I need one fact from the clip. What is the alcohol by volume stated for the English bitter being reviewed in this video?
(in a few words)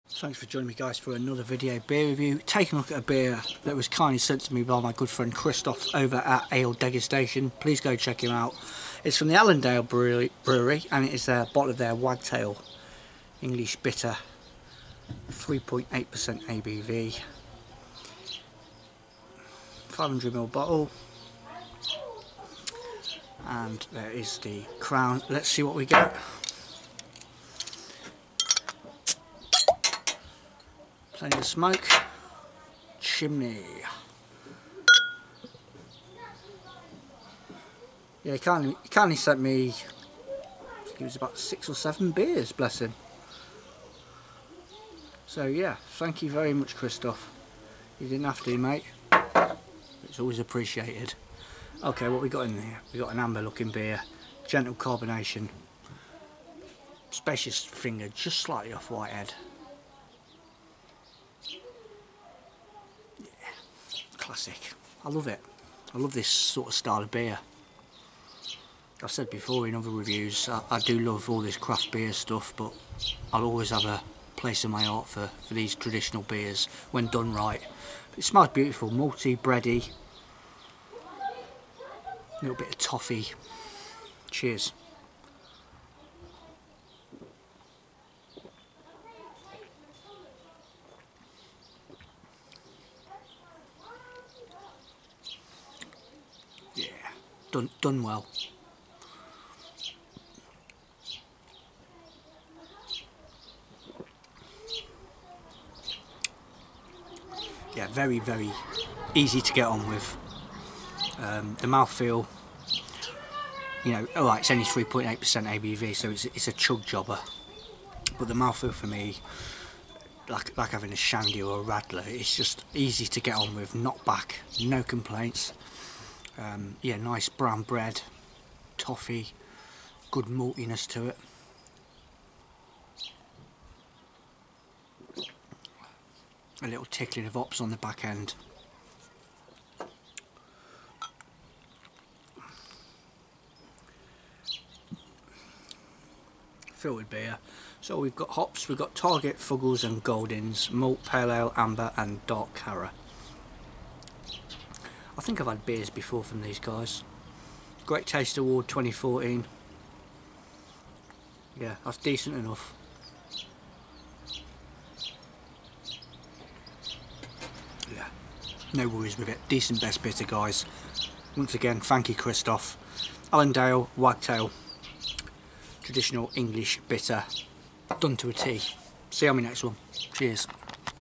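3.8%.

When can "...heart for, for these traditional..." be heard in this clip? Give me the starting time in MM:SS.
01:14.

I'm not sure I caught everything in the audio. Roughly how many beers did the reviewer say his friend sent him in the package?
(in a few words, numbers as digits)
six or seven.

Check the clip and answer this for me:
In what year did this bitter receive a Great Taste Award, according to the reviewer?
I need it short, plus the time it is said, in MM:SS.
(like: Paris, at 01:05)
2014, at 02:38.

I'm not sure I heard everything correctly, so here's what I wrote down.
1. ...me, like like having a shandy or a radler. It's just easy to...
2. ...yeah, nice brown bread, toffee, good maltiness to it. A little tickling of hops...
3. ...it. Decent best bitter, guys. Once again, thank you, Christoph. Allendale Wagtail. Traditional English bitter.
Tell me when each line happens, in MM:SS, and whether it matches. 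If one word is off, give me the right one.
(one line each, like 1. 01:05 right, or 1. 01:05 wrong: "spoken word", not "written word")
1. 01:58 right
2. 02:06 right
3. 02:49 right.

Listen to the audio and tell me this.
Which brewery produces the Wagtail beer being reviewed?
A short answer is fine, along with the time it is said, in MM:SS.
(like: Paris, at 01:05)
Allendale Brewery, at 00:09.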